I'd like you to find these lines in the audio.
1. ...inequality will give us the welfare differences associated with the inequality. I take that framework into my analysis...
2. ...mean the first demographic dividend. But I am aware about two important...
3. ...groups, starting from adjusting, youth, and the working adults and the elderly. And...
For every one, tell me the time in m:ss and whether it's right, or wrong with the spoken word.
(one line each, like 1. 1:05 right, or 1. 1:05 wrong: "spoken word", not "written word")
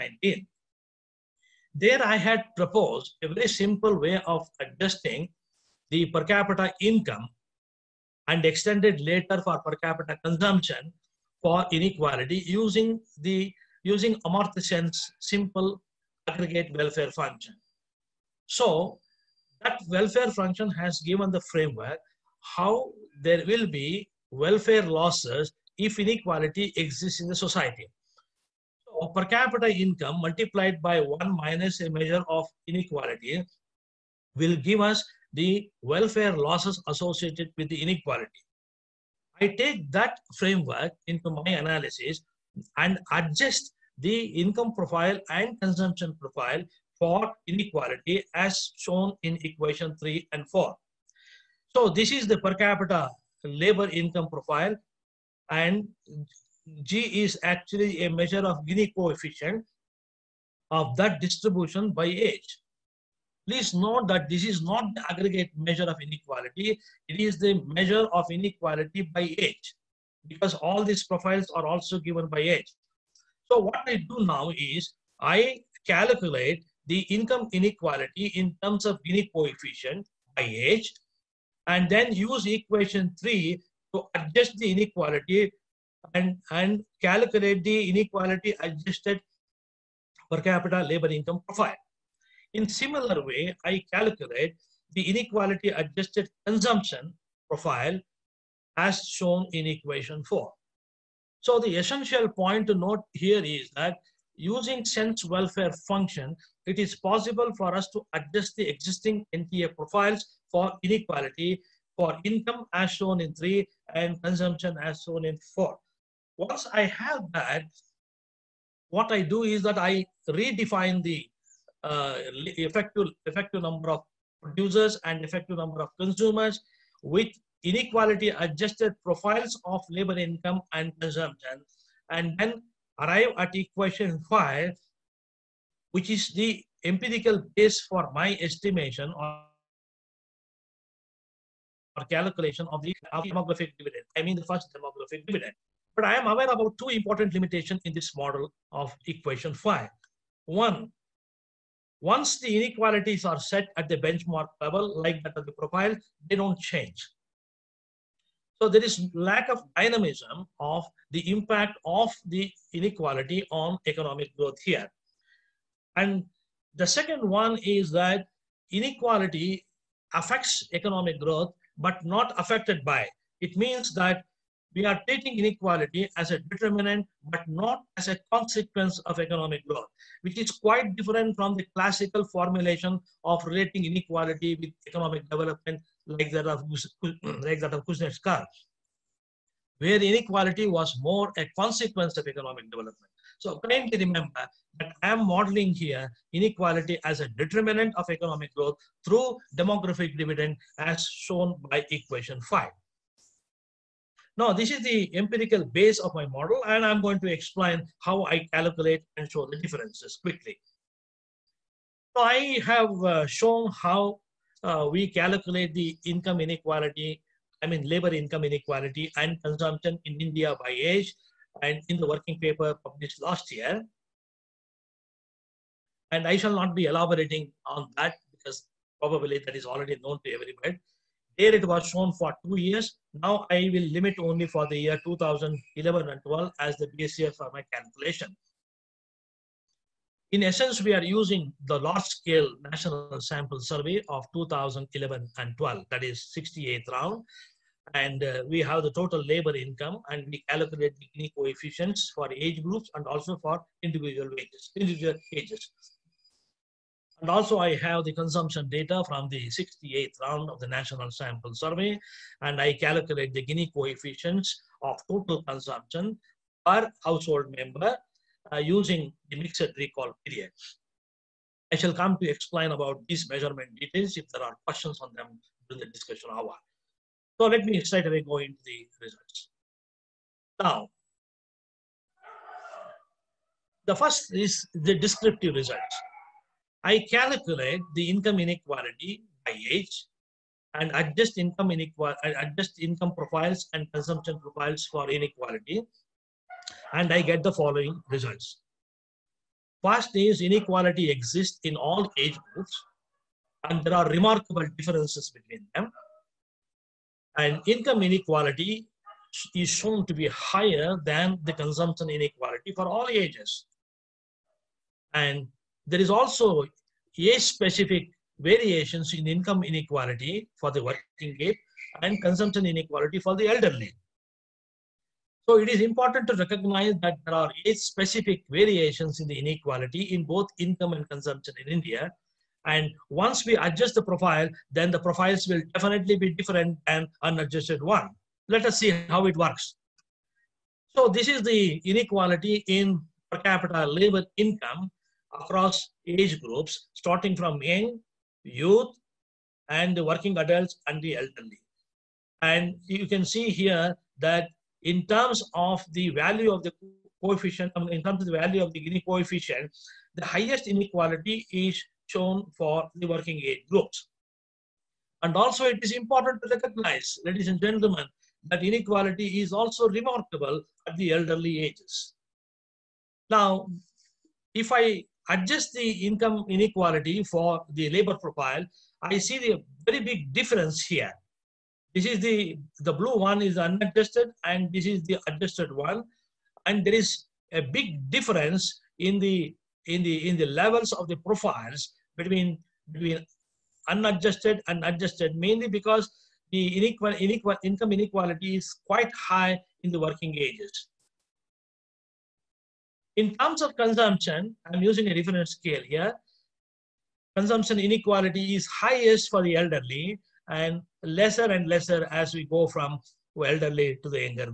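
1. 0:32 wrong: "losses", not "differences"
2. 2:24 right
3. 5:46 wrong: "young", not "adjusting".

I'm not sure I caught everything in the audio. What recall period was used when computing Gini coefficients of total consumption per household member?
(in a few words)
mixed recall period.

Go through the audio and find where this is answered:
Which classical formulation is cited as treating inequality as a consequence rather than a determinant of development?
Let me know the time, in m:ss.
3:07.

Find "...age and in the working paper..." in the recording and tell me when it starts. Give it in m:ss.
3:40.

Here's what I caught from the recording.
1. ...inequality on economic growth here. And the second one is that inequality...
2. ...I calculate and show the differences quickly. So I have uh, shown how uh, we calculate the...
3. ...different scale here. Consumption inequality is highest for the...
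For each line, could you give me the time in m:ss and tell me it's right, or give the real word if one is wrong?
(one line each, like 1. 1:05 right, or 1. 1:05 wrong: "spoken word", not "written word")
1. 2:42 right
2. 3:28 right
3. 6:45 right.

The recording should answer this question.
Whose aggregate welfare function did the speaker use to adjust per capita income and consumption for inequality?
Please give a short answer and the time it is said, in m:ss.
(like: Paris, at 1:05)
Amartya Sen, at 0:14.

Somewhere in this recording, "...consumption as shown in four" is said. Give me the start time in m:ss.
1:54.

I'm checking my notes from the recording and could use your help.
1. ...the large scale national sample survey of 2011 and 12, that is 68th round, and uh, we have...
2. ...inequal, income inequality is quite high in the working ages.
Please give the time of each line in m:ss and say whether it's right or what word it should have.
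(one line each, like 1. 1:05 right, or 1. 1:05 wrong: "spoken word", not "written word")
1. 4:01 right
2. 6:37 right.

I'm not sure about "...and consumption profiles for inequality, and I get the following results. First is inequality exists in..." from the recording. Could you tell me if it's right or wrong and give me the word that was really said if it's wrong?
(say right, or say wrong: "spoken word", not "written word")
right.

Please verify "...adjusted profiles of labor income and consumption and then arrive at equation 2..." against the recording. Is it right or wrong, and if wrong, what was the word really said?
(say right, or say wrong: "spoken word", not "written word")
wrong: "5", not "2".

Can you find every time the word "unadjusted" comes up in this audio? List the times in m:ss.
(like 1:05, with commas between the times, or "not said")
5:37, 6:23, 6:33.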